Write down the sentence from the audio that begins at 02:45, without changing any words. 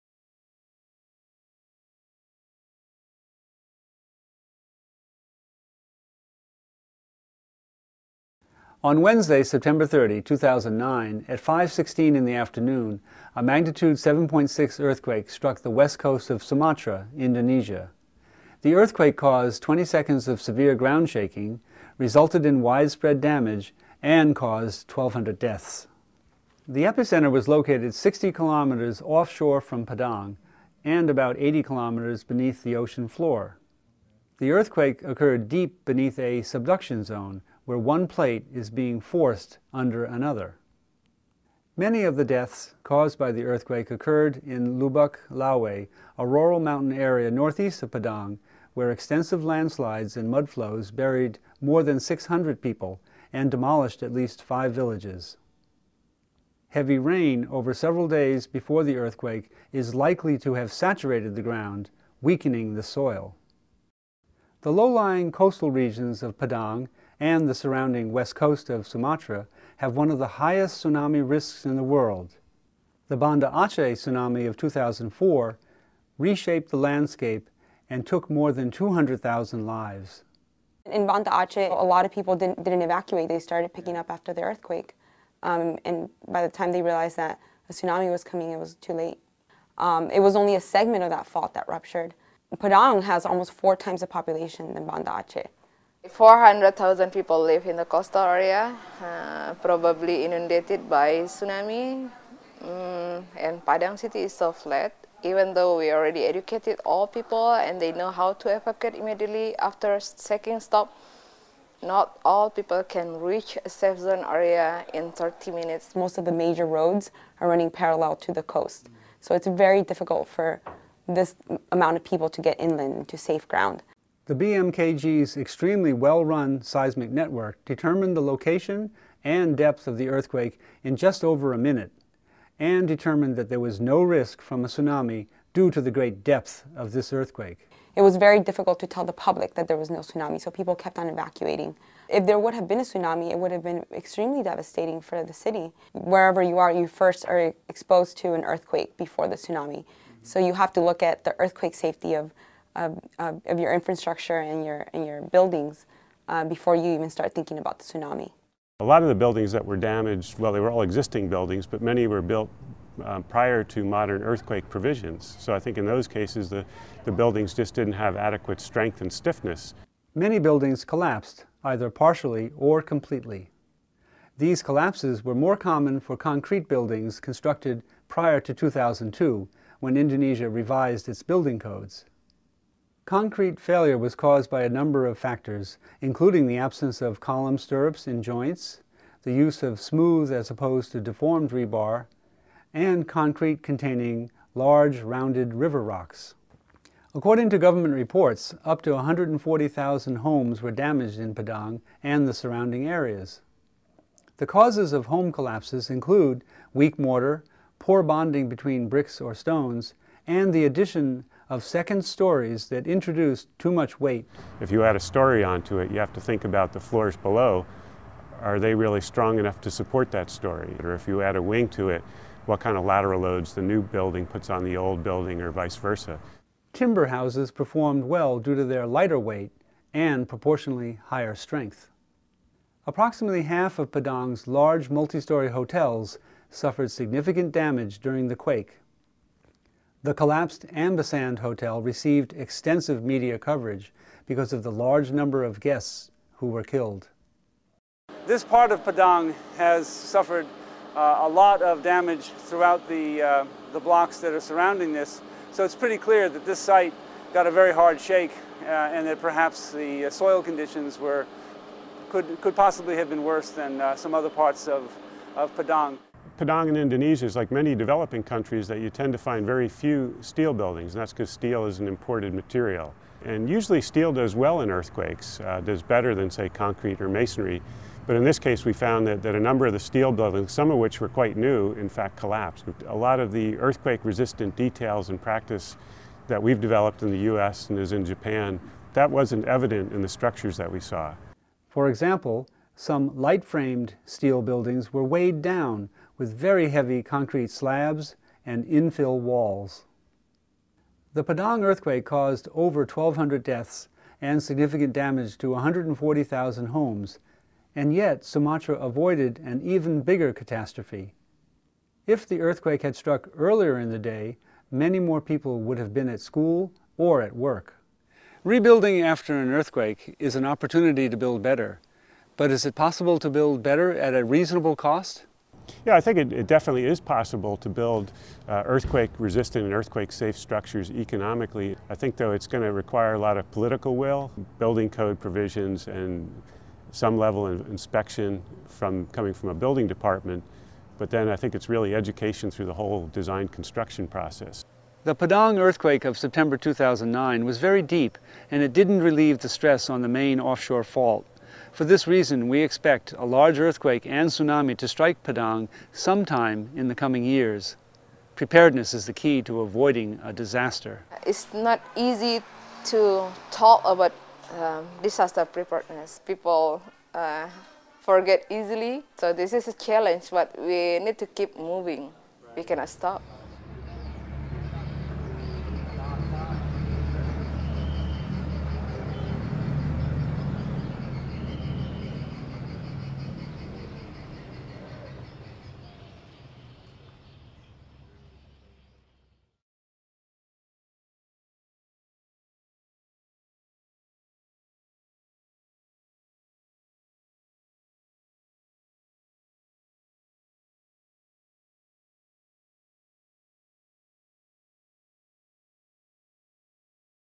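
So I think in those cases, the, the buildings just didn't have adequate strength and stiffness.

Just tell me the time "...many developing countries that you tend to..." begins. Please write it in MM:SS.
04:27.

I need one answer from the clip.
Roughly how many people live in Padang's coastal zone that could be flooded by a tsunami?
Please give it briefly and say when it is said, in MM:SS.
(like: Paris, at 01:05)
400,000, at 01:36.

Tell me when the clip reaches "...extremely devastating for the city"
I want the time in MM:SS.
02:23.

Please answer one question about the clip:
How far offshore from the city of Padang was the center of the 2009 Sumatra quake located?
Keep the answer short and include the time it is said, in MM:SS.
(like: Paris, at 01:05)
60 kilometers, at 00:27.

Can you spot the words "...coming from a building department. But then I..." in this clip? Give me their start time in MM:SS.
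05:39.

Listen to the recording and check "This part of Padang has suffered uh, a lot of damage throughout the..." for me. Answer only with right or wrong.
right.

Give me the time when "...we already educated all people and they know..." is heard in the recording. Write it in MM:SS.
01:45.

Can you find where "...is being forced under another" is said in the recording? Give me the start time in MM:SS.
00:38.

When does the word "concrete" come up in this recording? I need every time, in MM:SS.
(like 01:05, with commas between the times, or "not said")
02:56, 03:03, 03:13, 04:36, 04:57.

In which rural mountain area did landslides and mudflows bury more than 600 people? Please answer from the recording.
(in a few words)
Lubuk Lawe.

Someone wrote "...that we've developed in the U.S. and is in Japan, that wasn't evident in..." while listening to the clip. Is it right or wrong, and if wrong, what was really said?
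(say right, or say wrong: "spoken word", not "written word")
right.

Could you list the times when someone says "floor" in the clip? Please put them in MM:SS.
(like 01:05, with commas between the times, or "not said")
00:33, 03:36.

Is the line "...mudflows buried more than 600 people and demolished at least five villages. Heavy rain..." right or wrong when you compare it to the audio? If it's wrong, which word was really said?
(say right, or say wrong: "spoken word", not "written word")
right.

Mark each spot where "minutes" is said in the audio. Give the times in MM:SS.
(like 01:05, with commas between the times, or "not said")
01:55, 02:11.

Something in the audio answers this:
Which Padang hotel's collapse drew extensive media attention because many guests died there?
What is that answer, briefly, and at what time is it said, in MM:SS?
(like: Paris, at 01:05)
Ambacang Hotel, at 04:00.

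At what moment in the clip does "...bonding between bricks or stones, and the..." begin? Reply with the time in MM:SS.
03:28.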